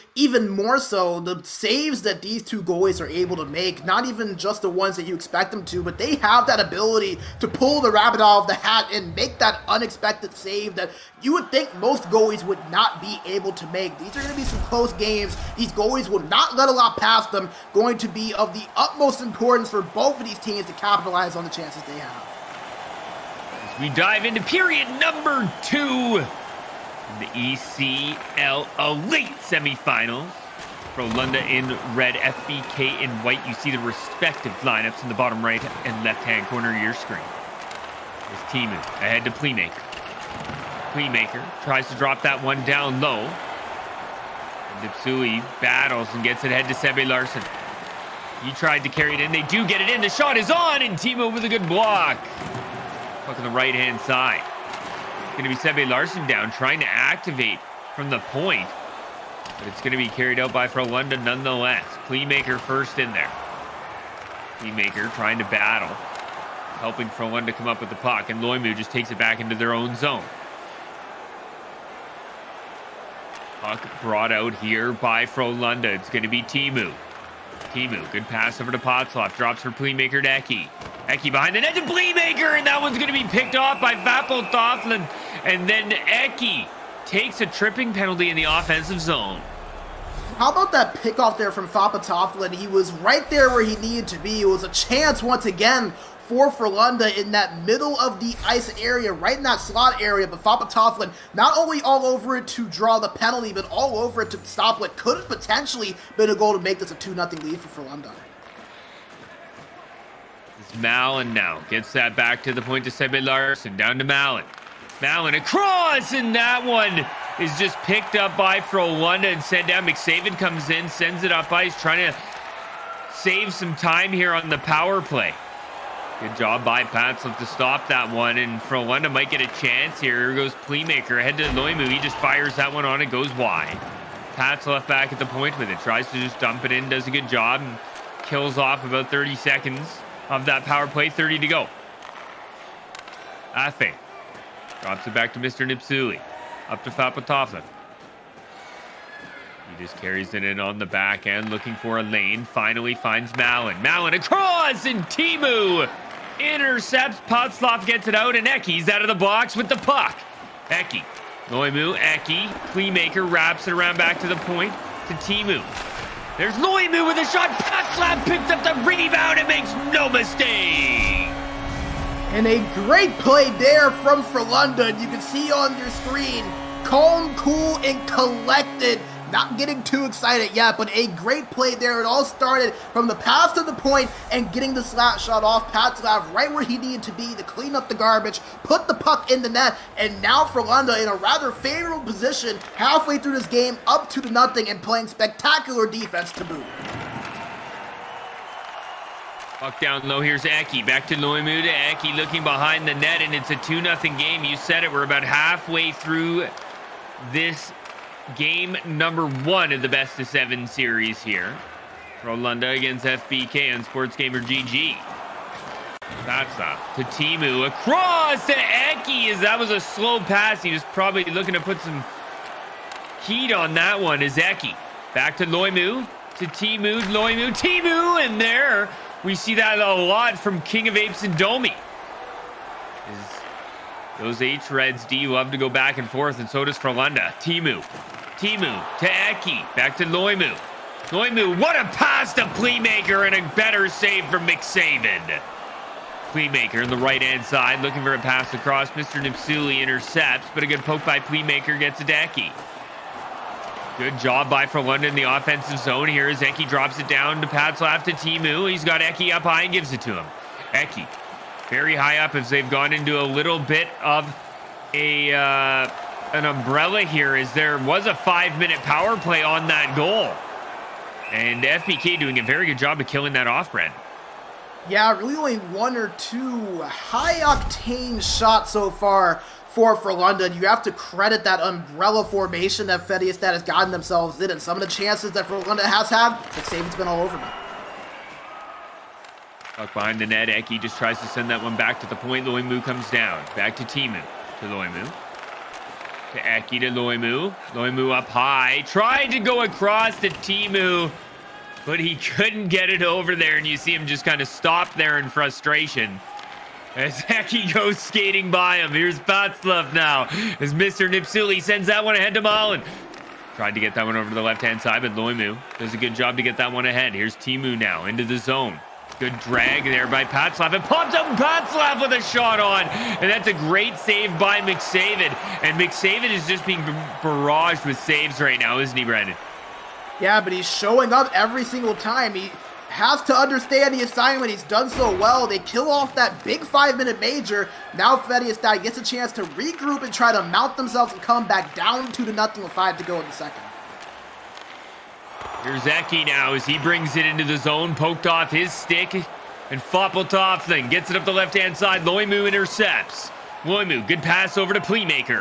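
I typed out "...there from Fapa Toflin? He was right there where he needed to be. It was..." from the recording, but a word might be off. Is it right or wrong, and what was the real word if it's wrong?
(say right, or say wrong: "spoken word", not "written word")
right.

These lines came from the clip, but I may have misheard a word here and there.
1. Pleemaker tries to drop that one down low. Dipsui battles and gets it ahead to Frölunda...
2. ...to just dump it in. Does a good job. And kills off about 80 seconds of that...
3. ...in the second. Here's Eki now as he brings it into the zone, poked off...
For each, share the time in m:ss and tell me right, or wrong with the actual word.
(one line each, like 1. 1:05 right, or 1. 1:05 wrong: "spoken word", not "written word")
1. 0:40 wrong: "Sebi", not "Frölunda"
2. 2:16 wrong: "30", not "80"
3. 5:43 right.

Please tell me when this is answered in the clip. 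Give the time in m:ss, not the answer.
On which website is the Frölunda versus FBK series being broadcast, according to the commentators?
3:33.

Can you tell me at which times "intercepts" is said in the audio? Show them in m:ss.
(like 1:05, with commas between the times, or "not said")
2:36, 4:09, 5:52.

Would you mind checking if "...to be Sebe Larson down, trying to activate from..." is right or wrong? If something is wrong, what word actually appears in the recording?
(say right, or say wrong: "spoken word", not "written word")
right.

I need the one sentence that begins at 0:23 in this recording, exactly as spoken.
As we dive into period number two, the ECL Elite semifinals.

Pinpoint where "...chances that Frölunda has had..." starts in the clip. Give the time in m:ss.
4:44.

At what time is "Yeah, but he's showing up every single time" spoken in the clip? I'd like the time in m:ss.
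5:30.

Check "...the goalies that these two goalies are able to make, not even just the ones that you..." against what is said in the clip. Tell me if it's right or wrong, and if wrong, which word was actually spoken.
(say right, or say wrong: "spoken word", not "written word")
wrong: "saves", not "goalies".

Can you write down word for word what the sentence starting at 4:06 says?
Playmaker in the right-hand side, looking for a pass across.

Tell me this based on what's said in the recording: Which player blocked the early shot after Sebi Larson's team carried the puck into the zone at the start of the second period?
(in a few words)
Timo.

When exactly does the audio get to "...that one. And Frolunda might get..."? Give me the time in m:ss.
2:07.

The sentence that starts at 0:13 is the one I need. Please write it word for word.
These are going to be some close games.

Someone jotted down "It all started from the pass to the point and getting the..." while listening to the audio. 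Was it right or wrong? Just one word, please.
right.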